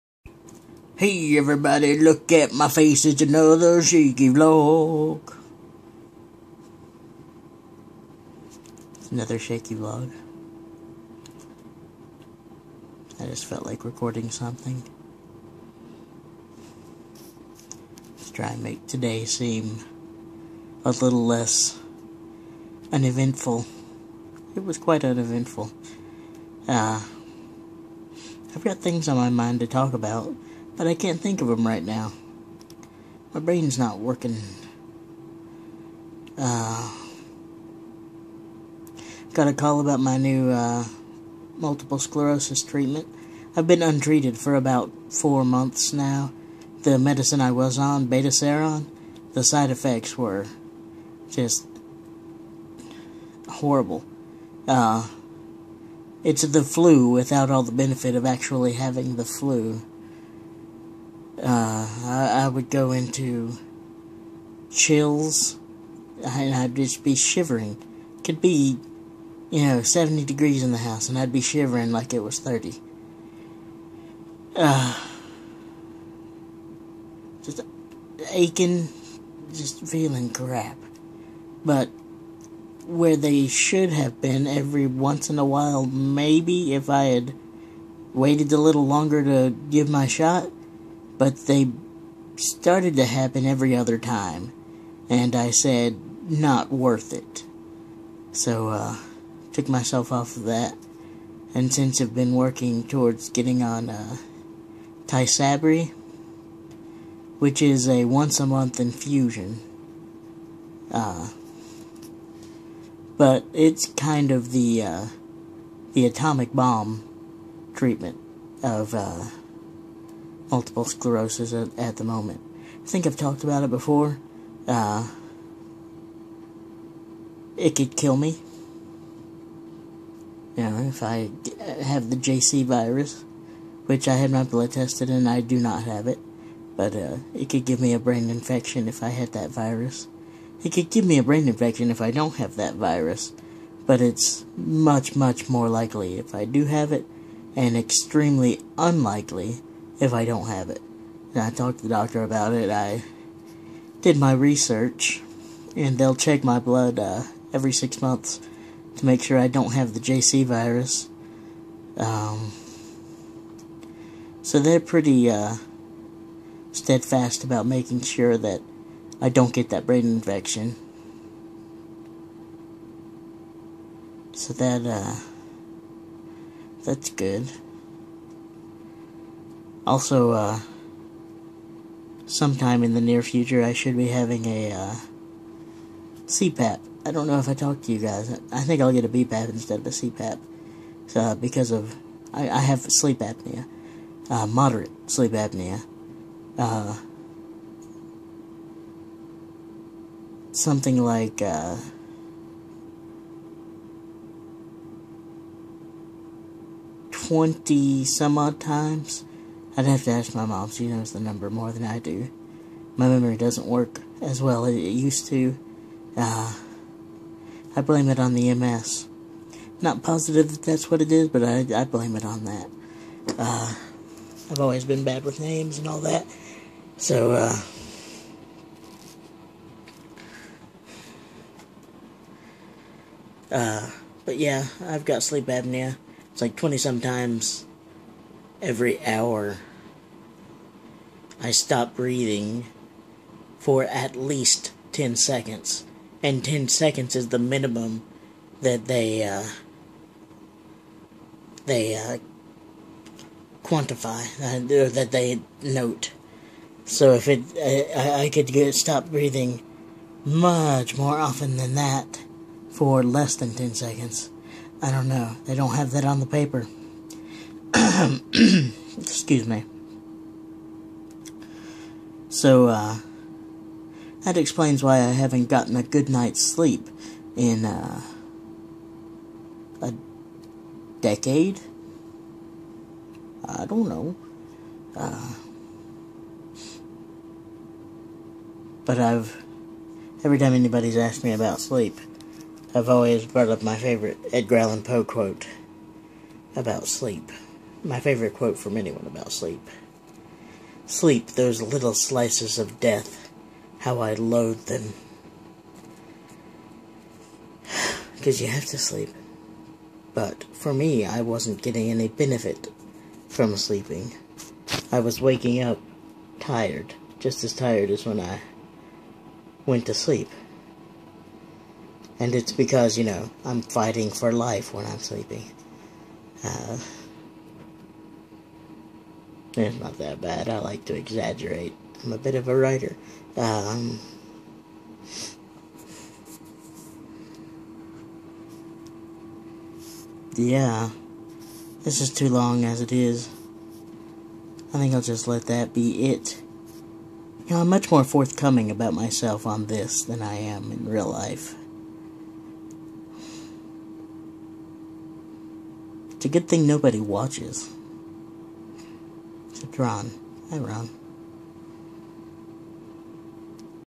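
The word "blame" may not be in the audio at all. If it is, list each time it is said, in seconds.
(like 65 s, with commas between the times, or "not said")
217 s, 221 s.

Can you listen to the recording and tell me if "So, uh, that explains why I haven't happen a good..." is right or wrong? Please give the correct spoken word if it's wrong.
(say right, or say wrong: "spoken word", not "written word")
wrong: "gotten", not "happen".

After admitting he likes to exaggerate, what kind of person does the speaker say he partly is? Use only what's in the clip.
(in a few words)
writer.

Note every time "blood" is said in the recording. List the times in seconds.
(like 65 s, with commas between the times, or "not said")
134 s, 156 s.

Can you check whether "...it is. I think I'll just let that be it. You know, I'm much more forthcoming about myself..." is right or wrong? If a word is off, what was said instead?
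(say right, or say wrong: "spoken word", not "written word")
right.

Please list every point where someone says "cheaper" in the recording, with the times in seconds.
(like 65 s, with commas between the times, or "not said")
not said.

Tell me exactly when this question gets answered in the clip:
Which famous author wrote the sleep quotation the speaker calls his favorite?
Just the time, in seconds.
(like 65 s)
294 s.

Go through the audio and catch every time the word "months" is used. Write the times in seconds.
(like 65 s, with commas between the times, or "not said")
45 s, 108 s, 158 s.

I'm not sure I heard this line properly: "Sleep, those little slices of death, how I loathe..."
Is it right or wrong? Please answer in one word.
right.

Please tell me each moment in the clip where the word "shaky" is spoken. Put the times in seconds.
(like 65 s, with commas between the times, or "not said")
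3 s, 9 s.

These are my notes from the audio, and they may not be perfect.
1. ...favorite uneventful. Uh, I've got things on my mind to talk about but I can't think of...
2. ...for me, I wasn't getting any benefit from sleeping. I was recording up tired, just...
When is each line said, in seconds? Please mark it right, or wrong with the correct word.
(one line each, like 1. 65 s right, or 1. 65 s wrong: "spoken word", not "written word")
1. 24 s wrong: "quite", not "favorite"
2. 310 s wrong: "waking", not "recording".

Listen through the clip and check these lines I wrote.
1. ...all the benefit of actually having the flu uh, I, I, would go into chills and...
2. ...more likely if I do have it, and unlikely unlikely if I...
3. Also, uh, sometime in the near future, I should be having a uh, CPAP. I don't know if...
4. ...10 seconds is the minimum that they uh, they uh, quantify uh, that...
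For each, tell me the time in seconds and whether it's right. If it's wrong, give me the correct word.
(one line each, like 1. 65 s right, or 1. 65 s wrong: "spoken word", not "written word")
1. 57 s right
2. 145 s wrong: "extremely", not "unlikely"
3. 179 s right
4. 246 s right.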